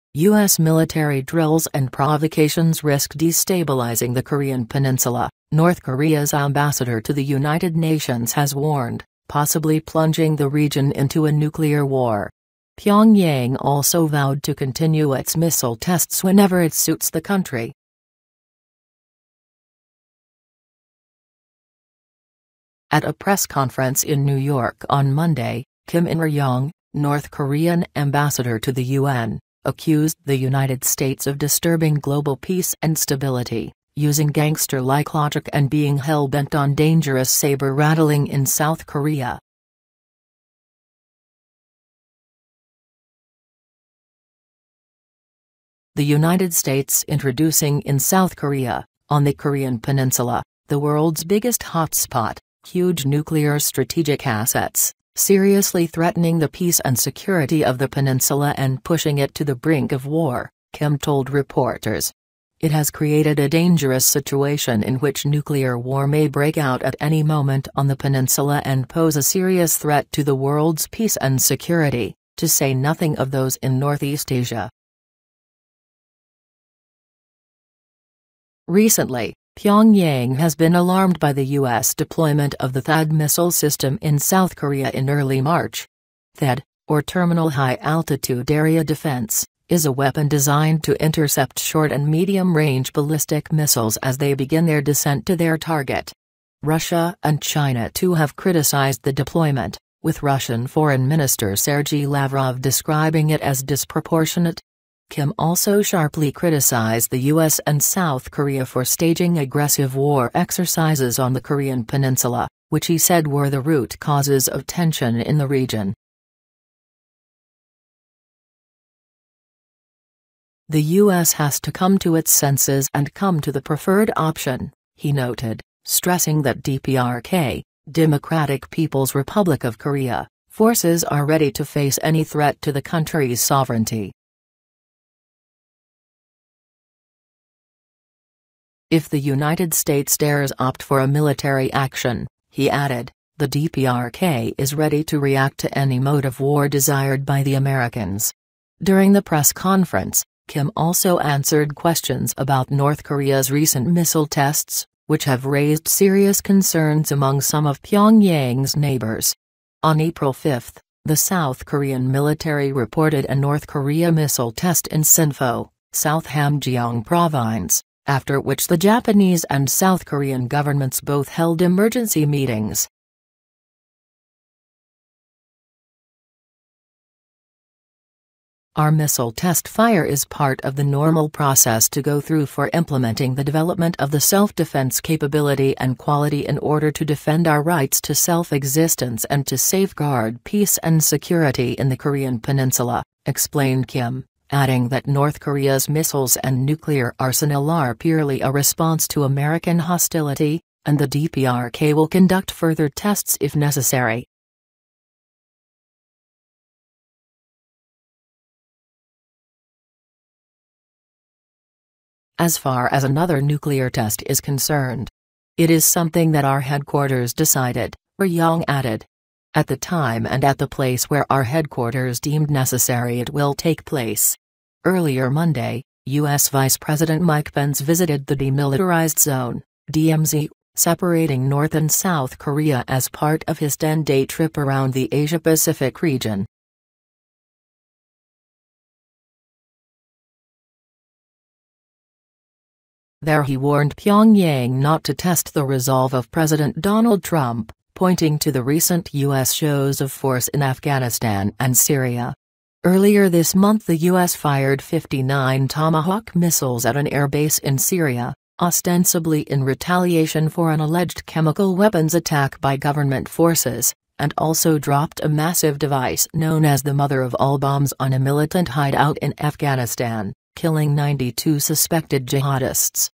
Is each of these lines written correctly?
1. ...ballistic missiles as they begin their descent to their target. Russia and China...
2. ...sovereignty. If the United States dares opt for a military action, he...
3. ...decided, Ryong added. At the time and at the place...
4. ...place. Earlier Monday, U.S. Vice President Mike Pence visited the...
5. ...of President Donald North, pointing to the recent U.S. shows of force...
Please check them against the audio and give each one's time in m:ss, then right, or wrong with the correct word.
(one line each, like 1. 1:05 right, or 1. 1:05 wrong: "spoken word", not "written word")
1. 1:32 right
2. 2:13 right
3. 3:37 right
4. 3:43 right
5. 4:06 wrong: "Trump", not "North".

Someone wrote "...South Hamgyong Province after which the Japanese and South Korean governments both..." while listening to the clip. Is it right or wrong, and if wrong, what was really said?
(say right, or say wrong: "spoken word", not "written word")
right.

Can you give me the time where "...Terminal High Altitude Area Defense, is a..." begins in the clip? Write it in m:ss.
1:27.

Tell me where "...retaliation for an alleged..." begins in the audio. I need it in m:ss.
4:19.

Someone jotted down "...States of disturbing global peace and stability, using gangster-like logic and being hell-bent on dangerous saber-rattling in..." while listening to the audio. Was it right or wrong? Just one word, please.
right.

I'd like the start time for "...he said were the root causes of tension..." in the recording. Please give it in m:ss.
1:52.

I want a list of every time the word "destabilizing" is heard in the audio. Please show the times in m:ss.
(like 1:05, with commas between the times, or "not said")
0:03.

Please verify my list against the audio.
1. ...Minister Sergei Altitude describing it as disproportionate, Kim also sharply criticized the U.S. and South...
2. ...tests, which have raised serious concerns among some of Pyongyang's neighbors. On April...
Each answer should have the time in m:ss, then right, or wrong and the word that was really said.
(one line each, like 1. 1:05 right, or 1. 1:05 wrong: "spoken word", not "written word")
1. 1:41 wrong: "Lavrov", not "Altitude"
2. 2:34 right.